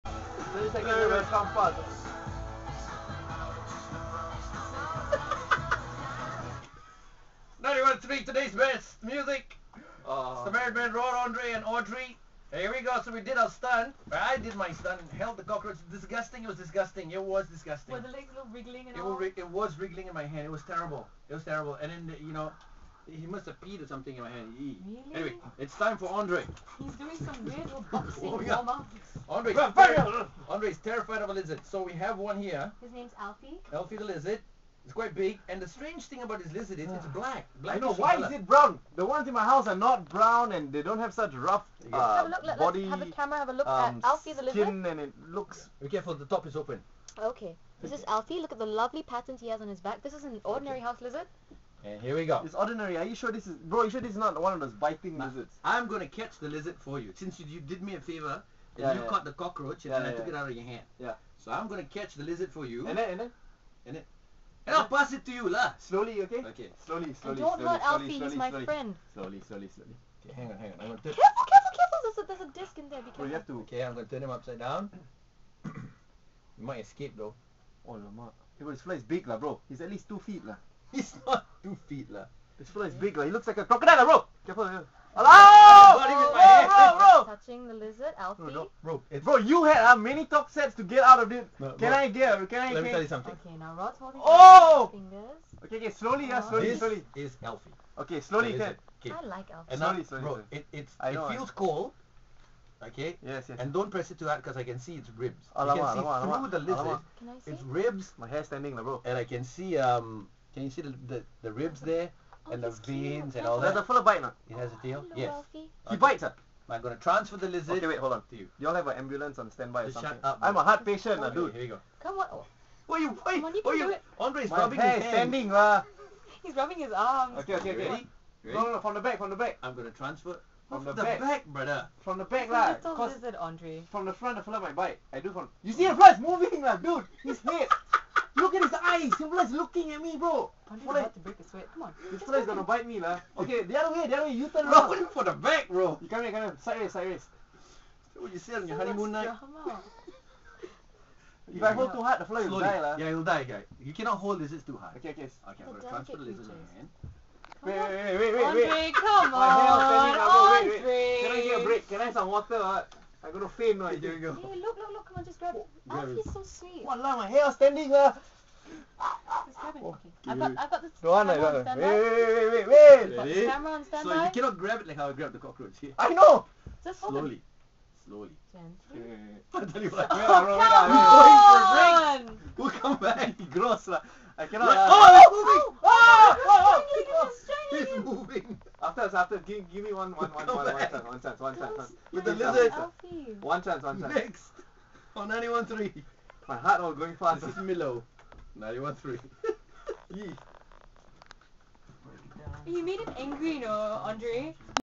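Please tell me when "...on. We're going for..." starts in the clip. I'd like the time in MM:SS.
03:02.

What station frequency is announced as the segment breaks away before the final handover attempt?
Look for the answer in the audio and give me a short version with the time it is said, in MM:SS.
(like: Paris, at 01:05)
91.3, at 03:15.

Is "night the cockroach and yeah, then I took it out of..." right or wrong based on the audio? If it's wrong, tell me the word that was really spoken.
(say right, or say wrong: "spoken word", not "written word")
wrong: "caught", not "night".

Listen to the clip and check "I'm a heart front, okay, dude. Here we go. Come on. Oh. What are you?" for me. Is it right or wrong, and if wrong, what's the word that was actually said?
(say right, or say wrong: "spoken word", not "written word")
wrong: "patient", not "front".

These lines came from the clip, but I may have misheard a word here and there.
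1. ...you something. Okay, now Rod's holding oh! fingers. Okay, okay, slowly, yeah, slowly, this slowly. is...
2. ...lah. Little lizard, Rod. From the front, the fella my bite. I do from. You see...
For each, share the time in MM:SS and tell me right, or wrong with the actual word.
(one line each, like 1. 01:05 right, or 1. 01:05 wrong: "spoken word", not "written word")
1. 01:33 right
2. 02:12 wrong: "Andre", not "Rod".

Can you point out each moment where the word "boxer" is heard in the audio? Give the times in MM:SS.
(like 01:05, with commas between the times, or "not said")
not said.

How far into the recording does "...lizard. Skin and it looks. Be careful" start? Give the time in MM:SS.
00:44.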